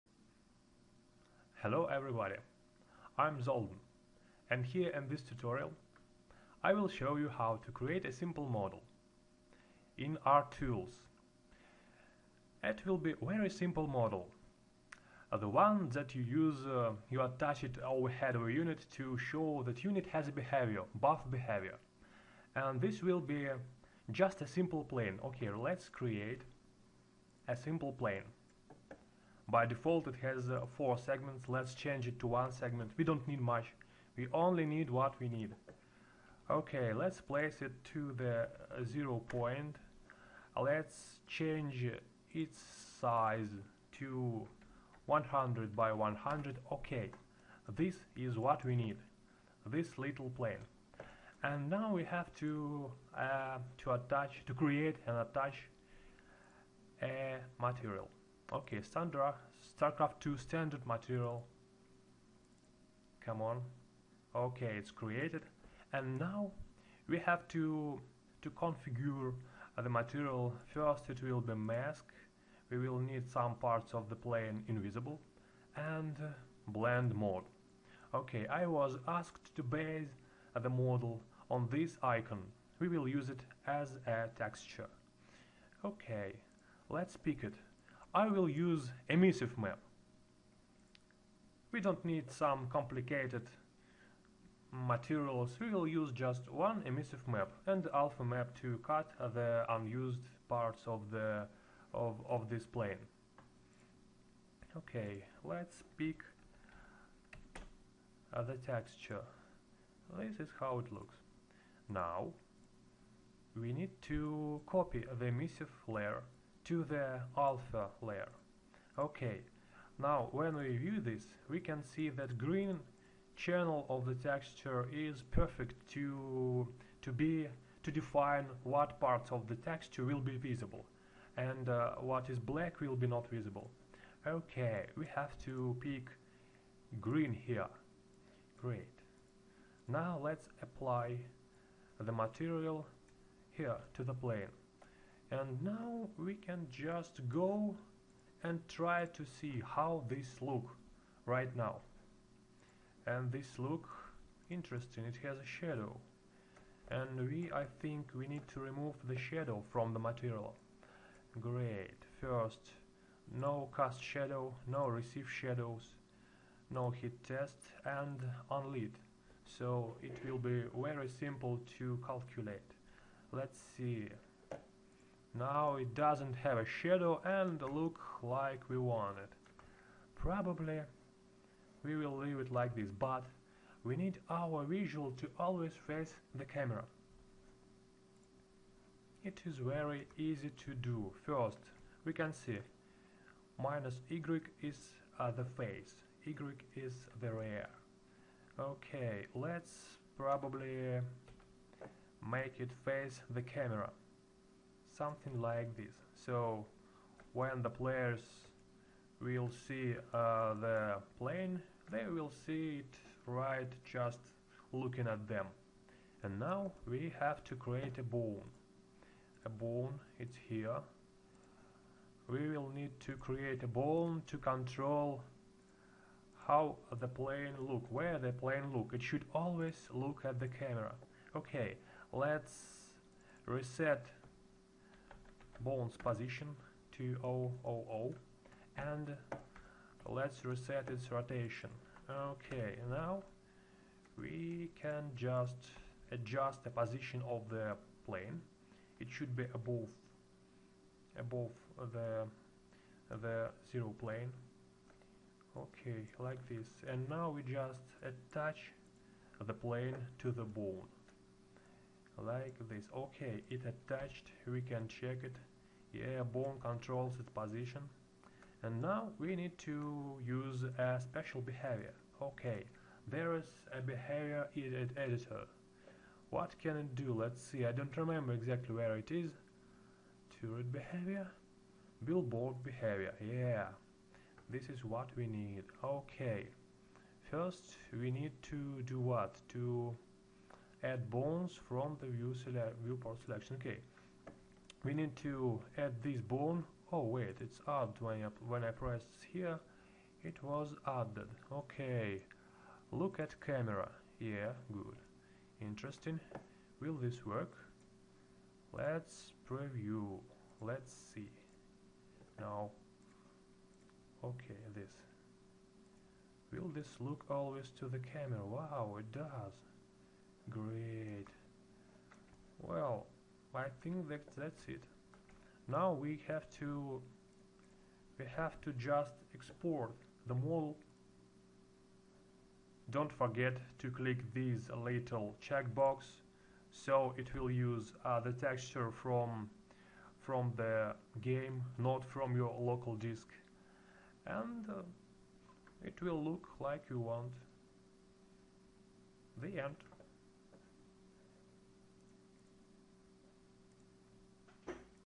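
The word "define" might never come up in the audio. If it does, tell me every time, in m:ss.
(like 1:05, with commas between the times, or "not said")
2:07.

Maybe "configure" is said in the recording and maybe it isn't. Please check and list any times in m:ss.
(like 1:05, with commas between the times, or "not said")
1:08.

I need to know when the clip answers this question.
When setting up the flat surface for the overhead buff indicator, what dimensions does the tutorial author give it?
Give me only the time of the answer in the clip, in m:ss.
0:45.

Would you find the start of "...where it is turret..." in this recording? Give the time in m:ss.
4:38.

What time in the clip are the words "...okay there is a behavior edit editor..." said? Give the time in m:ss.
4:32.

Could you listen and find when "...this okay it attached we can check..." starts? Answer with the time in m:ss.
4:22.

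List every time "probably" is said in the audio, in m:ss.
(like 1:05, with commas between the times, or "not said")
3:00, 3:20.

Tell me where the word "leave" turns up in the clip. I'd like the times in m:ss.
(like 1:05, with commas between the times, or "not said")
3:02.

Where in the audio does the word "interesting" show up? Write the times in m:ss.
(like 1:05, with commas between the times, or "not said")
2:34, 5:05.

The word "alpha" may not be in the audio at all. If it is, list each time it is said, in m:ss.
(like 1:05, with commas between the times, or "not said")
1:37, 1:57.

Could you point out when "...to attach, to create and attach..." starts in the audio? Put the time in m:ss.
0:53.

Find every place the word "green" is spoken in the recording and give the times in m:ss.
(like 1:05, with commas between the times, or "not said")
2:02, 2:16.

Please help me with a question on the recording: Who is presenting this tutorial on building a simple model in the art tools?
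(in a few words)
Zolden.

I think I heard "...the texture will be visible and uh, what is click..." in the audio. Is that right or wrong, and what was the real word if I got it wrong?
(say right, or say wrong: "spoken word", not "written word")
wrong: "black", not "click".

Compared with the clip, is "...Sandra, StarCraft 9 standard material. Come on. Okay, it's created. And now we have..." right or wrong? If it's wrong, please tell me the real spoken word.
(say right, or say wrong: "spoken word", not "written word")
wrong: "2", not "9".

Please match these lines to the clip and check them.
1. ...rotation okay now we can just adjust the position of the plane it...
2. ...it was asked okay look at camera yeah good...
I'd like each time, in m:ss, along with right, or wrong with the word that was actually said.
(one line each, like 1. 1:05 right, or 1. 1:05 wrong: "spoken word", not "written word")
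1. 4:01 right
2. 5:00 wrong: "added", not "asked".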